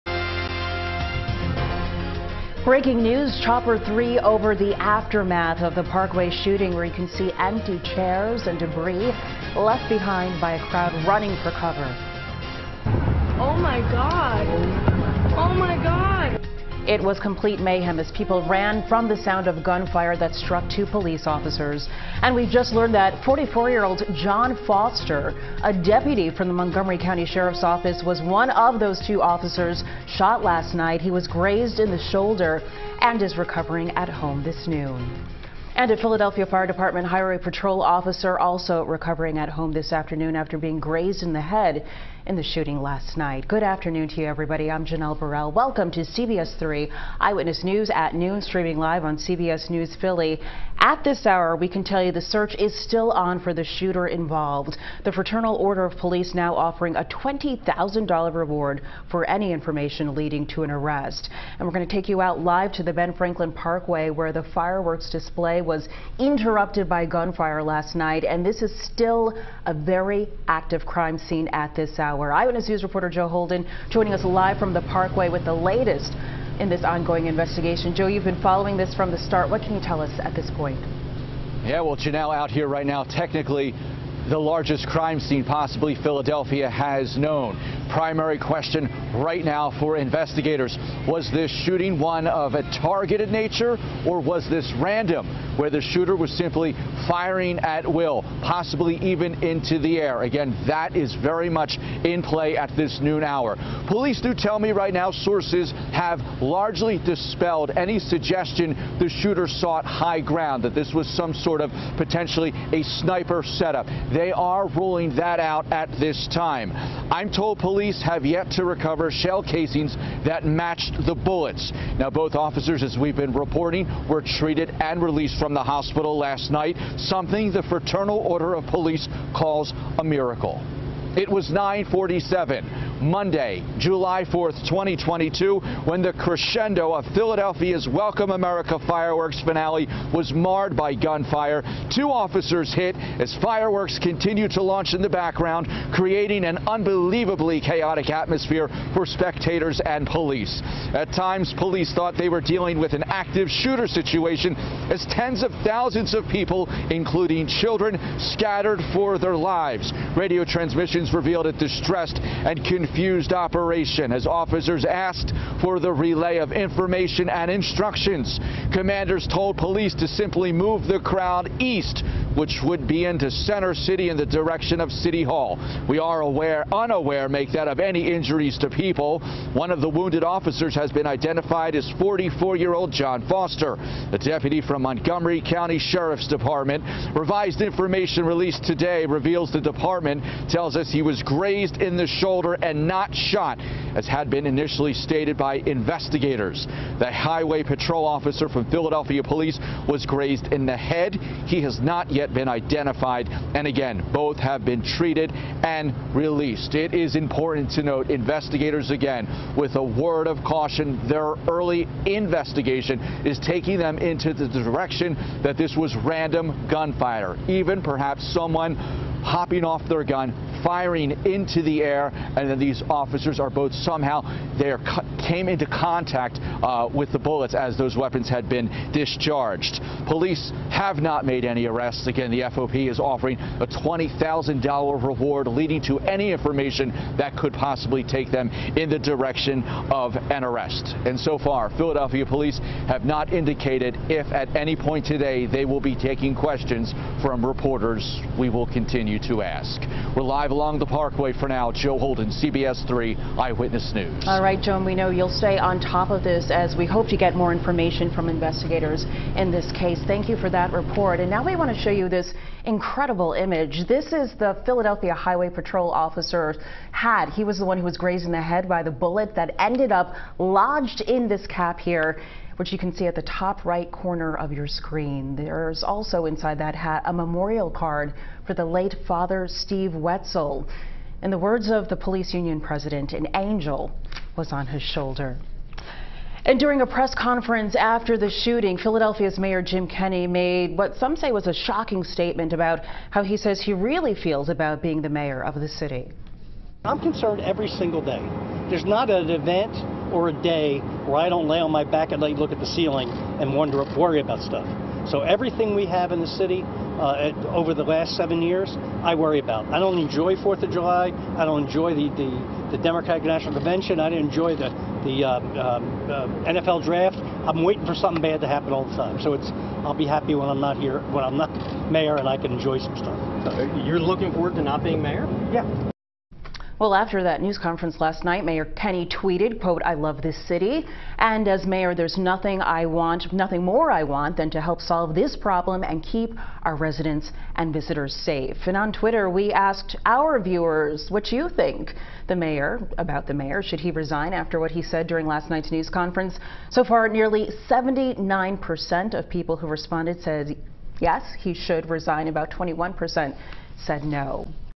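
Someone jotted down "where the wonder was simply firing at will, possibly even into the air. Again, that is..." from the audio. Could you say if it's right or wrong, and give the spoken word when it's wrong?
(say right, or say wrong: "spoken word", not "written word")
wrong: "shooter", not "wonder".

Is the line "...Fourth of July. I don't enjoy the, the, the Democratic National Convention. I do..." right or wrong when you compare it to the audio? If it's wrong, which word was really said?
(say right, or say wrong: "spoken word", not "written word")
right.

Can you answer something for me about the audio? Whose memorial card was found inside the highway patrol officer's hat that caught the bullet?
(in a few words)
Steve Wetzel.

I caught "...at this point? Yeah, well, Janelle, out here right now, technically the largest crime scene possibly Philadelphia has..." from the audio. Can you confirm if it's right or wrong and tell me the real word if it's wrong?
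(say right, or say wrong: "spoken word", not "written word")
right.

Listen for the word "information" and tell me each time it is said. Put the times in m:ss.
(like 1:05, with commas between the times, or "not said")
0:59, 2:46, 3:07, 3:56, 4:17.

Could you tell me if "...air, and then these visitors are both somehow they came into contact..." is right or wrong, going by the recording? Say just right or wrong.
wrong.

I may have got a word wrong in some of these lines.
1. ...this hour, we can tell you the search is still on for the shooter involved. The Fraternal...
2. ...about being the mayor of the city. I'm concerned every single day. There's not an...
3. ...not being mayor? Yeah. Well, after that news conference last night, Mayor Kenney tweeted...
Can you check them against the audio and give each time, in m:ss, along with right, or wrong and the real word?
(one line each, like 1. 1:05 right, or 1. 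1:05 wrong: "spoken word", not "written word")
1. 0:51 right
2. 4:54 right
3. 5:24 right.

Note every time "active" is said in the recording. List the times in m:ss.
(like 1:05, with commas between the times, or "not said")
1:10, 2:33.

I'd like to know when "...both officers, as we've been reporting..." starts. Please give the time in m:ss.
2:02.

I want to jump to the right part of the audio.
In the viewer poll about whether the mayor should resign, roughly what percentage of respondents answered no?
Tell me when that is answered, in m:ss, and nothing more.
5:52.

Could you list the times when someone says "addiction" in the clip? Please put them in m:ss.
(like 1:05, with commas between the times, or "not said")
not said.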